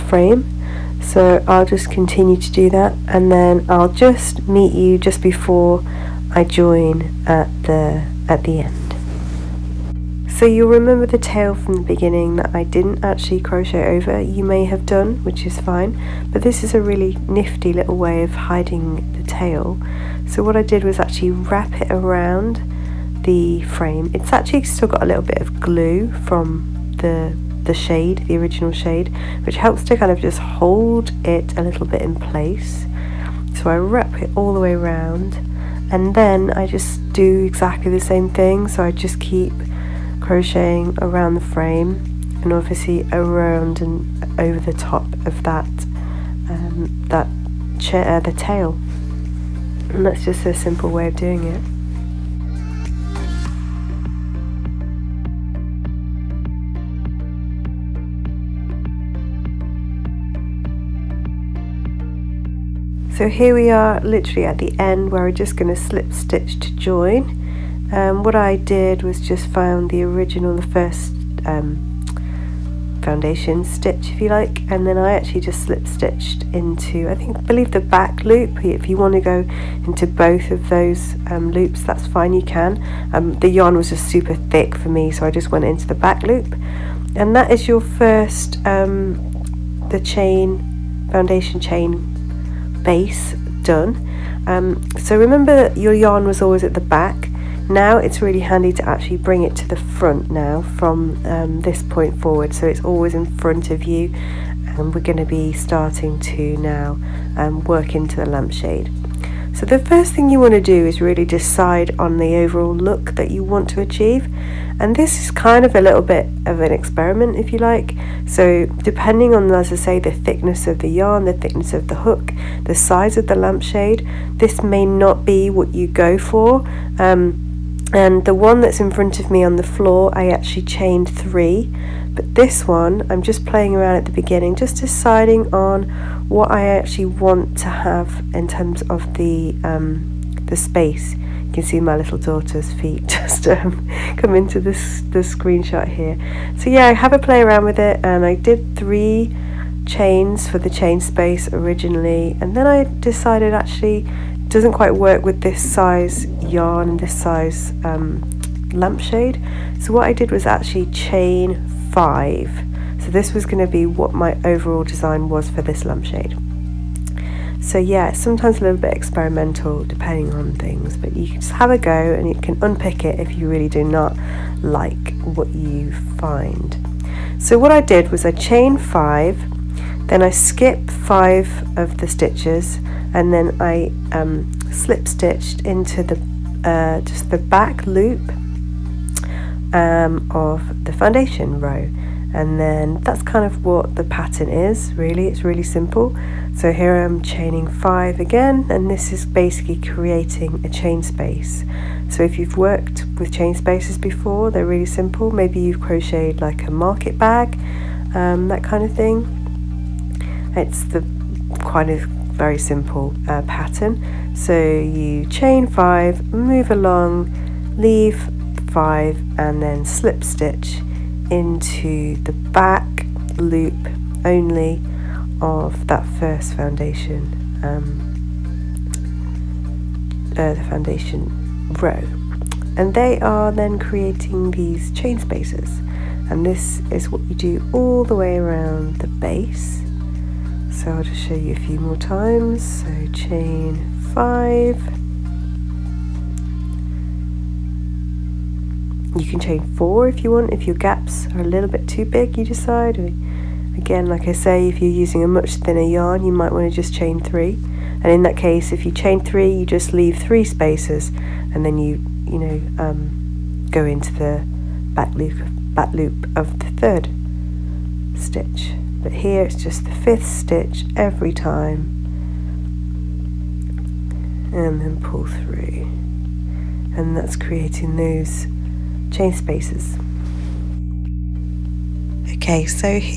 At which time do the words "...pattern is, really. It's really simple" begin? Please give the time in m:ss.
3:14.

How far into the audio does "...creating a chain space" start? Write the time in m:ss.
3:19.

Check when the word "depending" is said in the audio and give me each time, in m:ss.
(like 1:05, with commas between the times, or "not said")
1:58, 2:49.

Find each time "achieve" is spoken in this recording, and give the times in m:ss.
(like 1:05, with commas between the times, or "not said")
1:53.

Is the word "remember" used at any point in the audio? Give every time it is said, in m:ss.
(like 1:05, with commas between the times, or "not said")
0:10, 1:35.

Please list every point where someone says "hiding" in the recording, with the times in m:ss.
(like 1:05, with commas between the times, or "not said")
0:18.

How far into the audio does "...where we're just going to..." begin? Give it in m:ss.
1:05.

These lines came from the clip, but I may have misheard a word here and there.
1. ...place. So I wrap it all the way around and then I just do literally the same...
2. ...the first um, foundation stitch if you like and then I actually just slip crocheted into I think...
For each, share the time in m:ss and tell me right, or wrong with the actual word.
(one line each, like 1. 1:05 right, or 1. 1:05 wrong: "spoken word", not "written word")
1. 0:32 wrong: "exactly", not "literally"
2. 1:10 wrong: "stitched", not "crocheted".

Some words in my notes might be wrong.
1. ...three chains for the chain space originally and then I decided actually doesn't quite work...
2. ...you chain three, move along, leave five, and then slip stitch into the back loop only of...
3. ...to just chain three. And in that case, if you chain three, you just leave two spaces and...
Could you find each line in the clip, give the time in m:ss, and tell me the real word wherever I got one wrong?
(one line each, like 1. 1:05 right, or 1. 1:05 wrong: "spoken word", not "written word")
1. 2:28 right
2. 3:34 wrong: "five", not "three"
3. 4:16 wrong: "three", not "two".